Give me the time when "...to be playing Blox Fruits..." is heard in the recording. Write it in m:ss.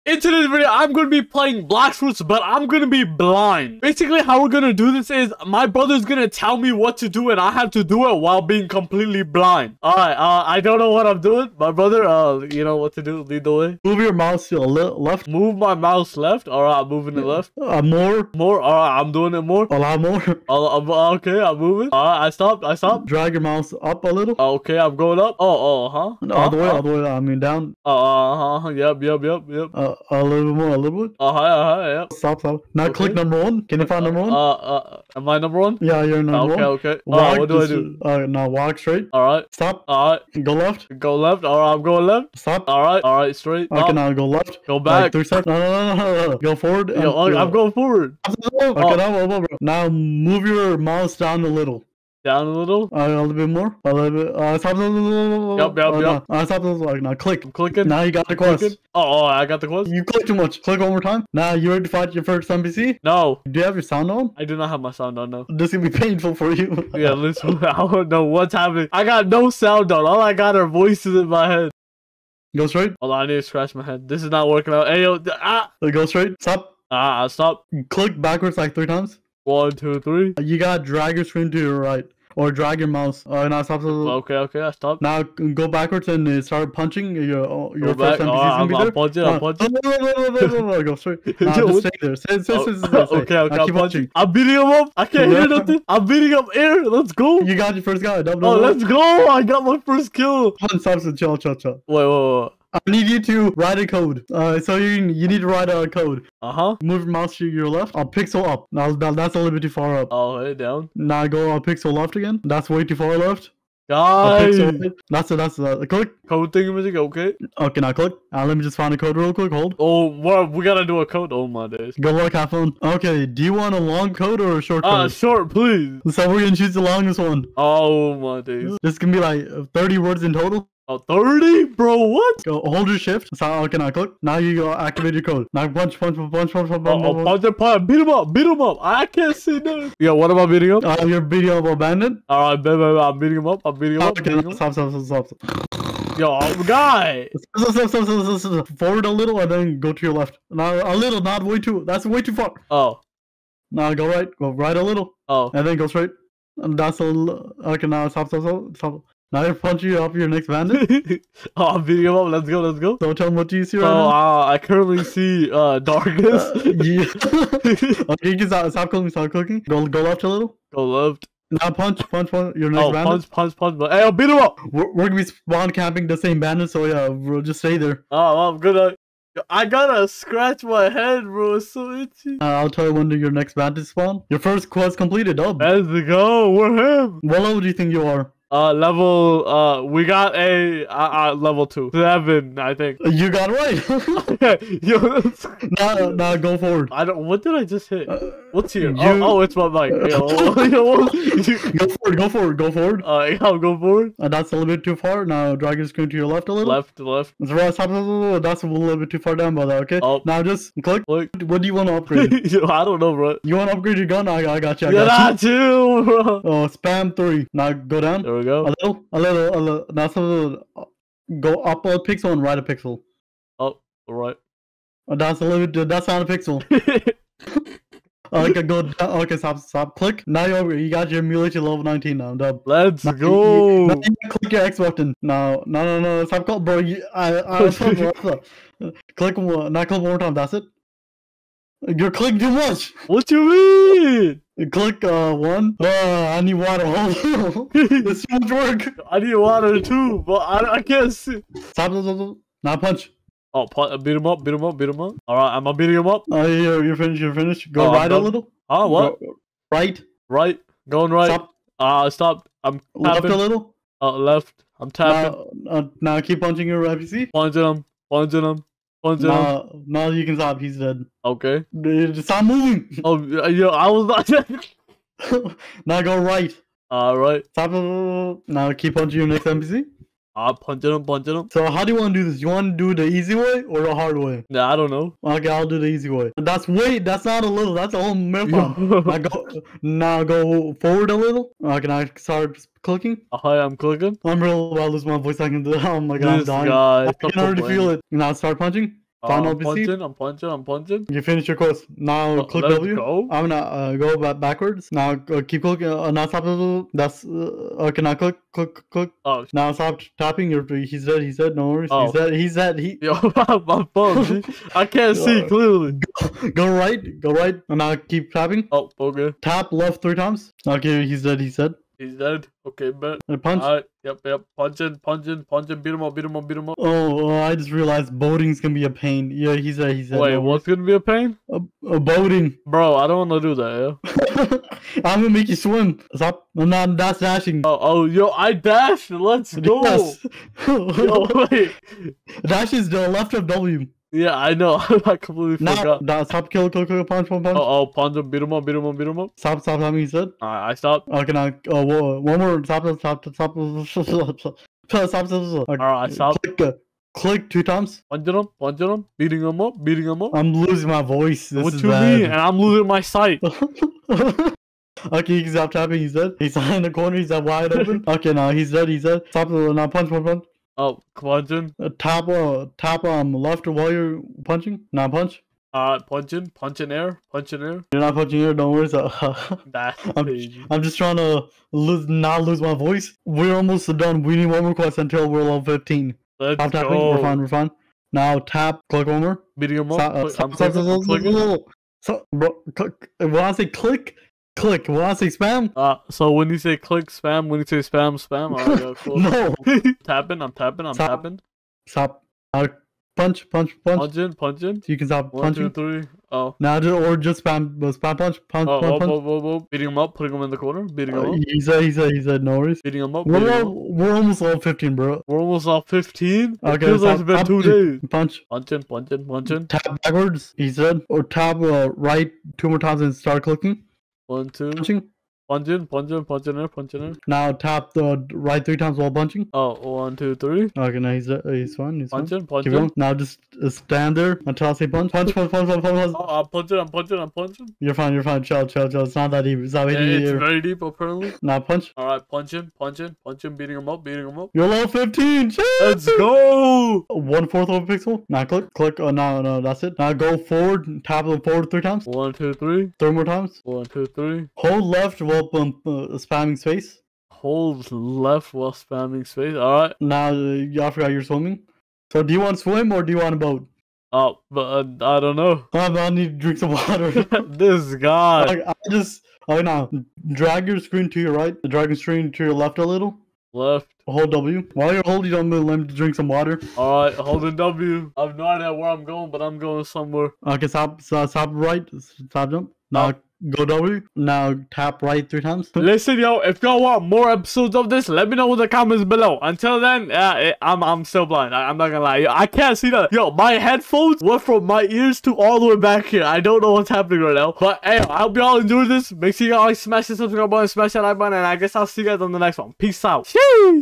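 0:01.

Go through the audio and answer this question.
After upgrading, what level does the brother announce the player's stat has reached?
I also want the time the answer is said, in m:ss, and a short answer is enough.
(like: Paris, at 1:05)
19, at 3:51.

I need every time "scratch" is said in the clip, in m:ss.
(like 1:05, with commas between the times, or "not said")
1:13, 3:00.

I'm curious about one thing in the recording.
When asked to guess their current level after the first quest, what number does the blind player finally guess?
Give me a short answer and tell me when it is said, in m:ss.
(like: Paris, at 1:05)
7, at 3:11.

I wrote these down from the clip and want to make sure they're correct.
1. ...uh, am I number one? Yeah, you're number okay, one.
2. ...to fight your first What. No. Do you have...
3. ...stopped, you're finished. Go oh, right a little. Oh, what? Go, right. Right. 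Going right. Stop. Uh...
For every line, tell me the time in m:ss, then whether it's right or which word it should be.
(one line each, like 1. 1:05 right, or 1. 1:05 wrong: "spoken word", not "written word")
1. 0:34 right
2. 1:01 wrong: "NPC", not "What"
3. 4:16 wrong: "finished", not "stopped".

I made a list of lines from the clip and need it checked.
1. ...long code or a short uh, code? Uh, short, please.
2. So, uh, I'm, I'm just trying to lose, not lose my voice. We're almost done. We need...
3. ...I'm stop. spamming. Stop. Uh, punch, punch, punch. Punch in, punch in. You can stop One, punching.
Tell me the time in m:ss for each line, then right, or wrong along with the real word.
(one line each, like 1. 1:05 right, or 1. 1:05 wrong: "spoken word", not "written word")
1. 2:03 right
2. 6:18 right
3. 6:40 wrong: "tapping", not "spamming".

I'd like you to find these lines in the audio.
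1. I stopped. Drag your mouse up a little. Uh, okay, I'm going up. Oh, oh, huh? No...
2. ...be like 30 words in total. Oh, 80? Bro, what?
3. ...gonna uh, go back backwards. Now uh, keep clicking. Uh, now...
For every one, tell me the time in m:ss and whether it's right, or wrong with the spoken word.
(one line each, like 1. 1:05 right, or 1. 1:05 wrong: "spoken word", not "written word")
1. 0:22 right
2. 2:09 wrong: "30", not "80"
3. 5:03 right.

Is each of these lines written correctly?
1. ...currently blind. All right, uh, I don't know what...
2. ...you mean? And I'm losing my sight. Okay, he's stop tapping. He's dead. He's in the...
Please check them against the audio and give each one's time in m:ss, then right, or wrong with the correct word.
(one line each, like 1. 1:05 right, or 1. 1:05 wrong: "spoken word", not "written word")
1. 0:08 wrong: "completely", not "currently"
2. 6:01 right.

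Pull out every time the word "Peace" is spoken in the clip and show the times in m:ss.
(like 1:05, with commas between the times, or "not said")
8:22.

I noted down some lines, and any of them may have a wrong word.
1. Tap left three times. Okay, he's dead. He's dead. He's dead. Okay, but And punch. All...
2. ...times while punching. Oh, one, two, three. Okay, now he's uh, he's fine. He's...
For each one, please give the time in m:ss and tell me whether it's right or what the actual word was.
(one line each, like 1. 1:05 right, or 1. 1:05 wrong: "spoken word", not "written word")
1. 5:19 right
2. 7:08 right.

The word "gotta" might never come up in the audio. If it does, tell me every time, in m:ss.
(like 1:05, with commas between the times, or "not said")
1:20, 2:00, 2:59.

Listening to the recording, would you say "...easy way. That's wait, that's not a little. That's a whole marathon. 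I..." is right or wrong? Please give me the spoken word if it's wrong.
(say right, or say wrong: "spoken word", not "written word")
right.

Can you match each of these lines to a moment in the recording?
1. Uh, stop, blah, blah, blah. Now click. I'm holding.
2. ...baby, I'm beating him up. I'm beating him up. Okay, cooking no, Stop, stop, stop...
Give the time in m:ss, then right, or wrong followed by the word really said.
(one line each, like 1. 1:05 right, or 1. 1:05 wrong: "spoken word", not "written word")
1. 0:56 wrong: "clicking", not "holding"
2. 2:22 wrong: "beating", not "cooking".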